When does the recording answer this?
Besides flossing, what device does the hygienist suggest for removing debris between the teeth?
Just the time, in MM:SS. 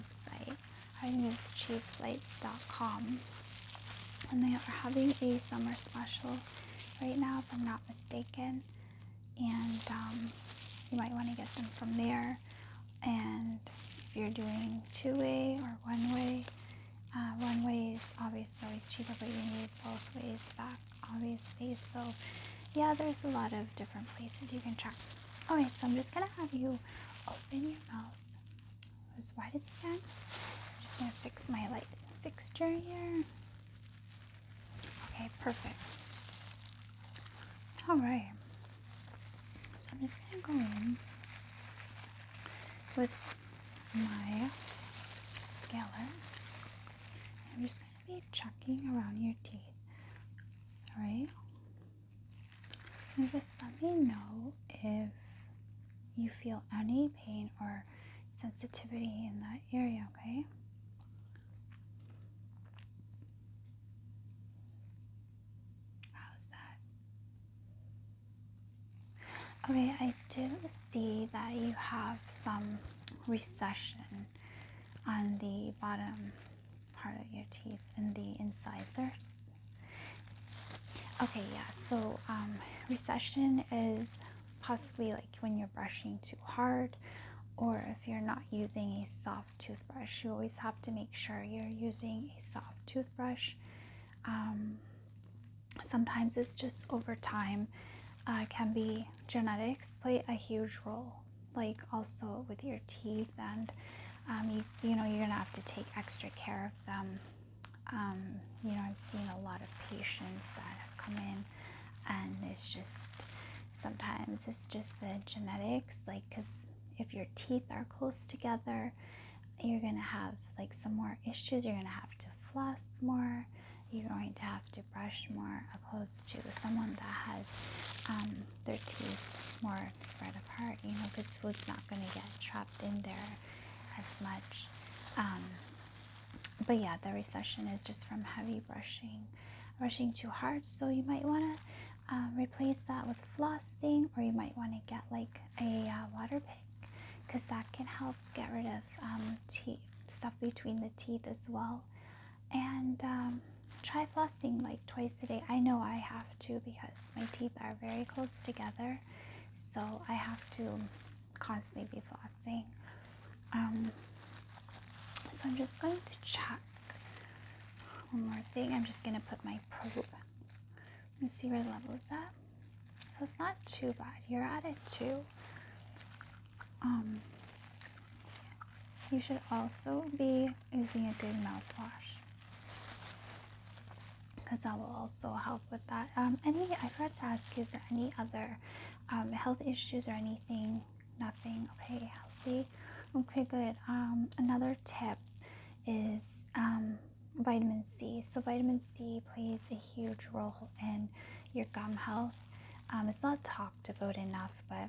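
02:26.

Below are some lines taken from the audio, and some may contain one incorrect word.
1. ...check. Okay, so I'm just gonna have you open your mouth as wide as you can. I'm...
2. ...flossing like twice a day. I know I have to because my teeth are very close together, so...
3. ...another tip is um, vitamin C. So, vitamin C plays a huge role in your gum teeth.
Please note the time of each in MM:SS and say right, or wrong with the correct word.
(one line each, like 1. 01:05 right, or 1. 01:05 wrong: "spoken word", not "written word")
1. 00:24 right
2. 02:34 right
3. 03:14 wrong: "health", not "teeth".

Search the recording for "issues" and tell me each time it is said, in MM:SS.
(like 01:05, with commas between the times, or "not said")
02:01, 03:09.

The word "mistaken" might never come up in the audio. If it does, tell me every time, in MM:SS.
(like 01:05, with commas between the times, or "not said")
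00:07.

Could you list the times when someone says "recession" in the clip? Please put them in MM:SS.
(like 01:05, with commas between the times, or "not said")
01:13, 01:22, 02:17.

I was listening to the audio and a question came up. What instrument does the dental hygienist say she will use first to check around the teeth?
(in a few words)
scaler.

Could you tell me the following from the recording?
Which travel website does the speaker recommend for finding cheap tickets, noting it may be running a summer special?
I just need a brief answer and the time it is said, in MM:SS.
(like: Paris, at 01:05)
cheapflights.com, at 00:01.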